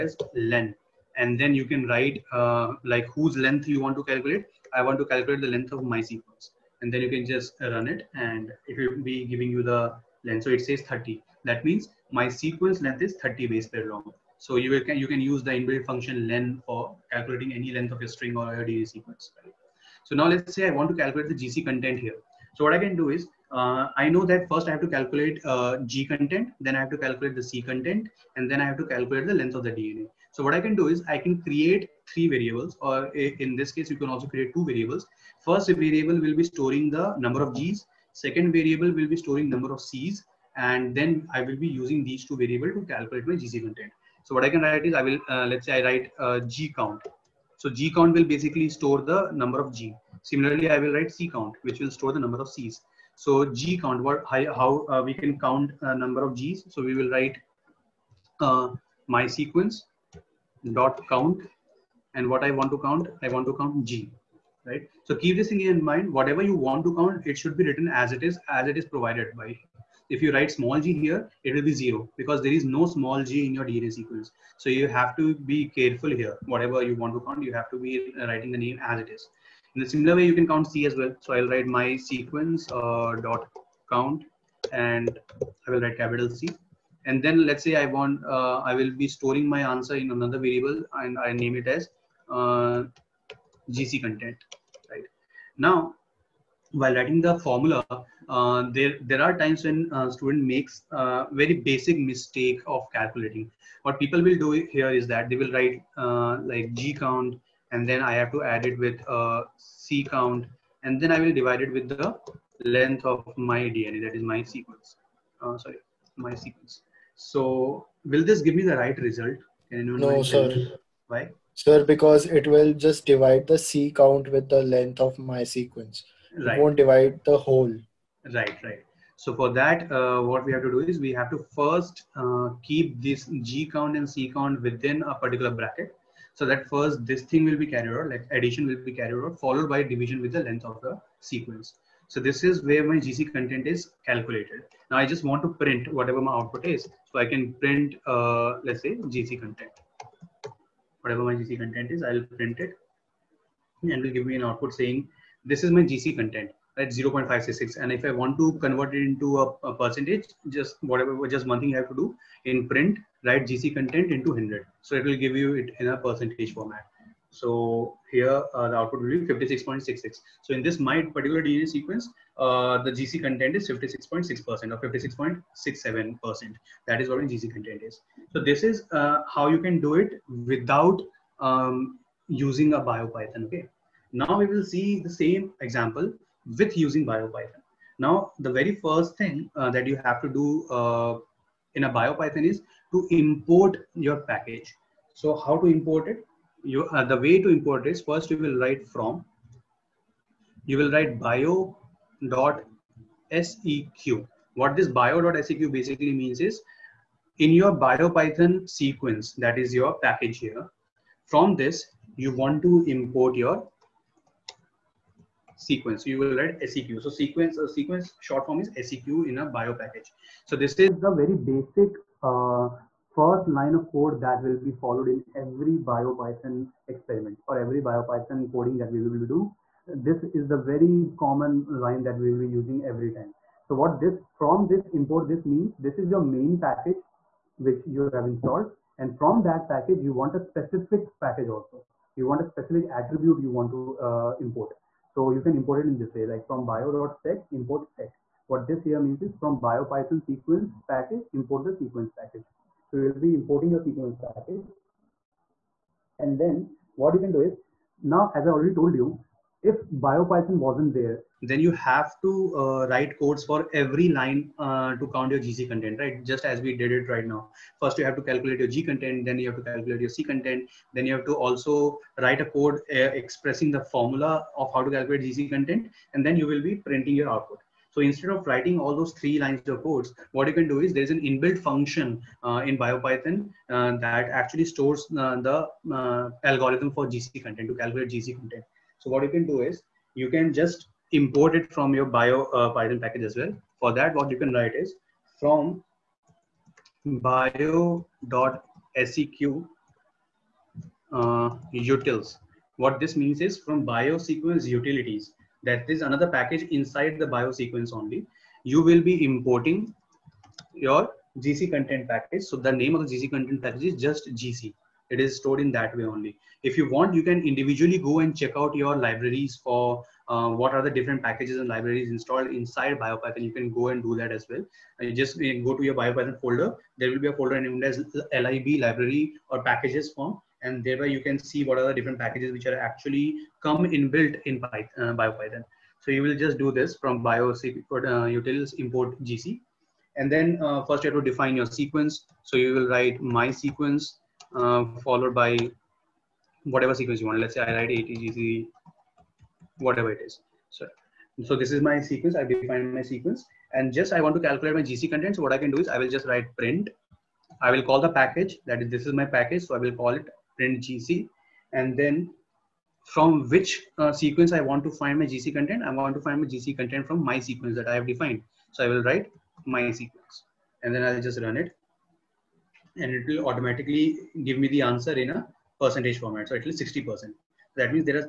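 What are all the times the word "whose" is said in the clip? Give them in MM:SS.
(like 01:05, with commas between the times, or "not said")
00:03.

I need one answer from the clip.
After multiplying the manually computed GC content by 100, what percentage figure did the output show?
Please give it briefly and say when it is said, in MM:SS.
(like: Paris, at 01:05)
56.66, at 02:49.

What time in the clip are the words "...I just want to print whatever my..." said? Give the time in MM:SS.
02:24.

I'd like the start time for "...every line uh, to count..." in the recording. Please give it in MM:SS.
04:23.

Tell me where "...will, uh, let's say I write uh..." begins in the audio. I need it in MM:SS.
00:45.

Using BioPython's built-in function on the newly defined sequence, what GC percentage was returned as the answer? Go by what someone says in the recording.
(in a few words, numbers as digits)
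60%.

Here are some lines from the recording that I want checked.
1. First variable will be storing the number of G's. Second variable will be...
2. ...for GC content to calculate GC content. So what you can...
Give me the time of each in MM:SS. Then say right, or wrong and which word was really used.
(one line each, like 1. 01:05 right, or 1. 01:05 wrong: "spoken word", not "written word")
1. 00:35 right
2. 04:46 right.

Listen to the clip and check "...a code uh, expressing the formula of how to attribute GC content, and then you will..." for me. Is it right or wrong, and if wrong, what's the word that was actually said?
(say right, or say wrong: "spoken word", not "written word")
wrong: "calculate", not "attribute".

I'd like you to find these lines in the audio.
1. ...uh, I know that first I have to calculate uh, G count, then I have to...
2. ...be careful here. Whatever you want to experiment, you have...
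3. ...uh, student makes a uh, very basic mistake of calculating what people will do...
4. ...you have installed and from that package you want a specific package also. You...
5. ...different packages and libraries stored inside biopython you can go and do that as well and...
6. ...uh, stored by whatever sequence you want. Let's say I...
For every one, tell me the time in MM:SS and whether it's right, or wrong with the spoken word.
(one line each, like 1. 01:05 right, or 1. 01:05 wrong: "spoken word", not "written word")
1. 00:23 wrong: "content", not "count"
2. 01:15 wrong: "count", not "experiment"
3. 01:40 right
4. 03:57 right
5. 05:20 wrong: "installed", not "stored"
6. 05:44 wrong: "followed", not "stored".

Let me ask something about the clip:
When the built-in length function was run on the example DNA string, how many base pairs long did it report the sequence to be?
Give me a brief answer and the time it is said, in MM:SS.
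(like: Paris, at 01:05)
30, at 00:10.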